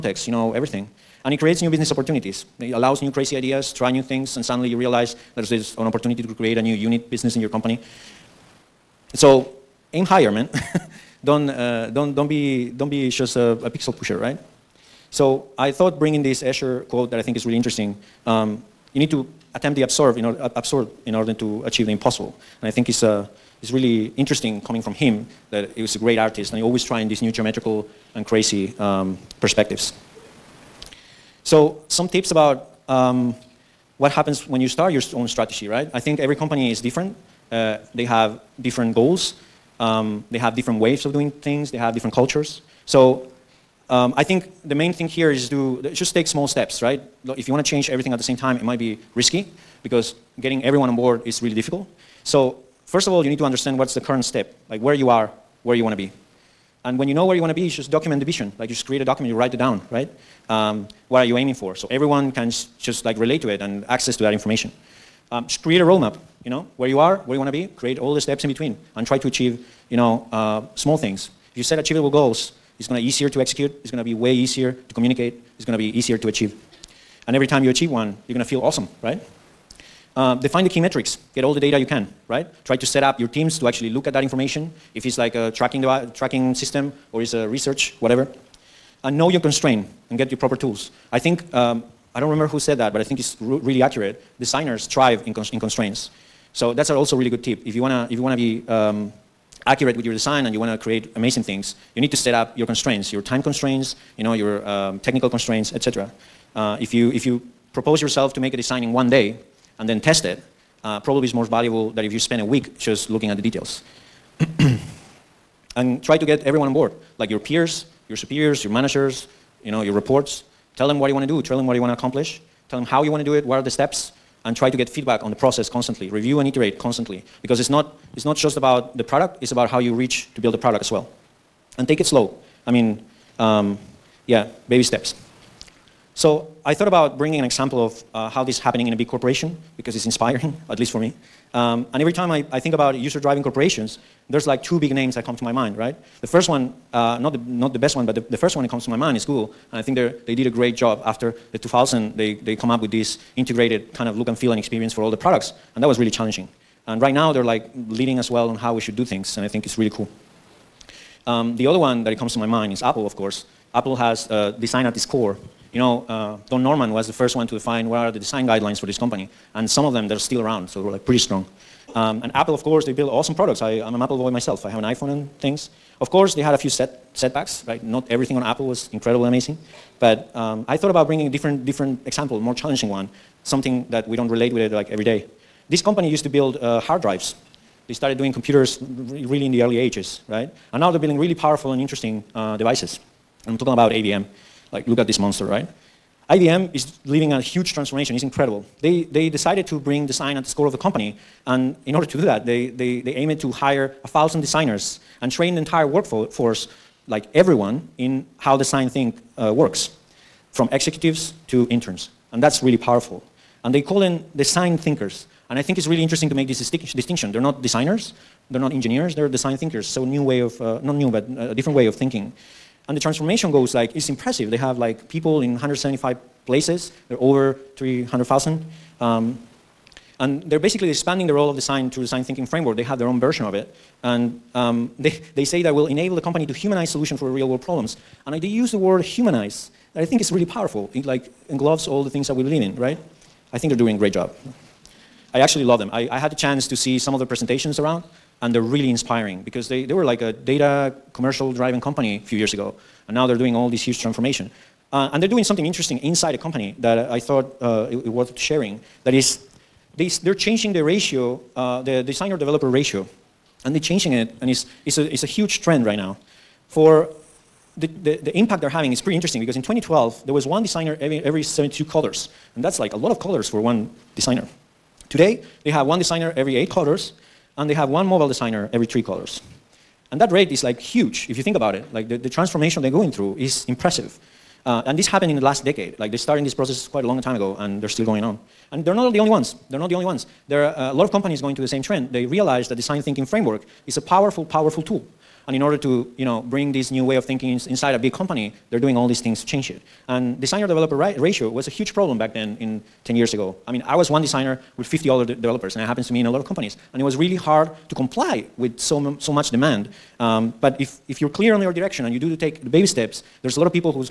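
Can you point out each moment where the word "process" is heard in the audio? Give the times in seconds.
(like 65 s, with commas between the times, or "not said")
125 s, 286 s.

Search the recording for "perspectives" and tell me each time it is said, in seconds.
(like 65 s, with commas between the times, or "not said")
29 s.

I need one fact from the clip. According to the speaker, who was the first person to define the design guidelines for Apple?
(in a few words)
Don Norman.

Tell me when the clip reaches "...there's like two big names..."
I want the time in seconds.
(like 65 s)
144 s.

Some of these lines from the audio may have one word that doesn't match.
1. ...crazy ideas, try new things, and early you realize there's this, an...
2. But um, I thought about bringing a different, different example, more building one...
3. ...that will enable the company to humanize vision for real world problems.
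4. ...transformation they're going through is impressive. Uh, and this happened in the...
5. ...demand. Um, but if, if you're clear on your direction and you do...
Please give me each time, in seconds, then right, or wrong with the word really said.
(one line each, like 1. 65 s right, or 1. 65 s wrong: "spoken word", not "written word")
1. 3 s wrong: "suddenly", not "early"
2. 180 s wrong: "challenging", not "building"
3. 235 s wrong: "solution", not "vision"
4. 282 s right
5. 309 s right.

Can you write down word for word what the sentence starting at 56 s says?
And when you know where you want to be, you just document the vision.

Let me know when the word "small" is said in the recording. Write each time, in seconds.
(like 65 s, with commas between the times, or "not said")
46 s, 70 s.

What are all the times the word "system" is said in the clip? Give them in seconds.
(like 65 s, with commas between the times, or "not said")
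86 s.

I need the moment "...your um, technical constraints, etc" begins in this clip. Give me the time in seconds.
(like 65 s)
104 s.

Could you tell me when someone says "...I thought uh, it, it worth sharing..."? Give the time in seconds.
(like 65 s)
257 s.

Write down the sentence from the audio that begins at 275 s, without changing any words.
Today, they have one designer every eight colors, and they have one mobile designer every three colors.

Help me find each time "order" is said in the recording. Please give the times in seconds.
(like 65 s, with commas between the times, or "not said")
21 s, 201 s, 295 s.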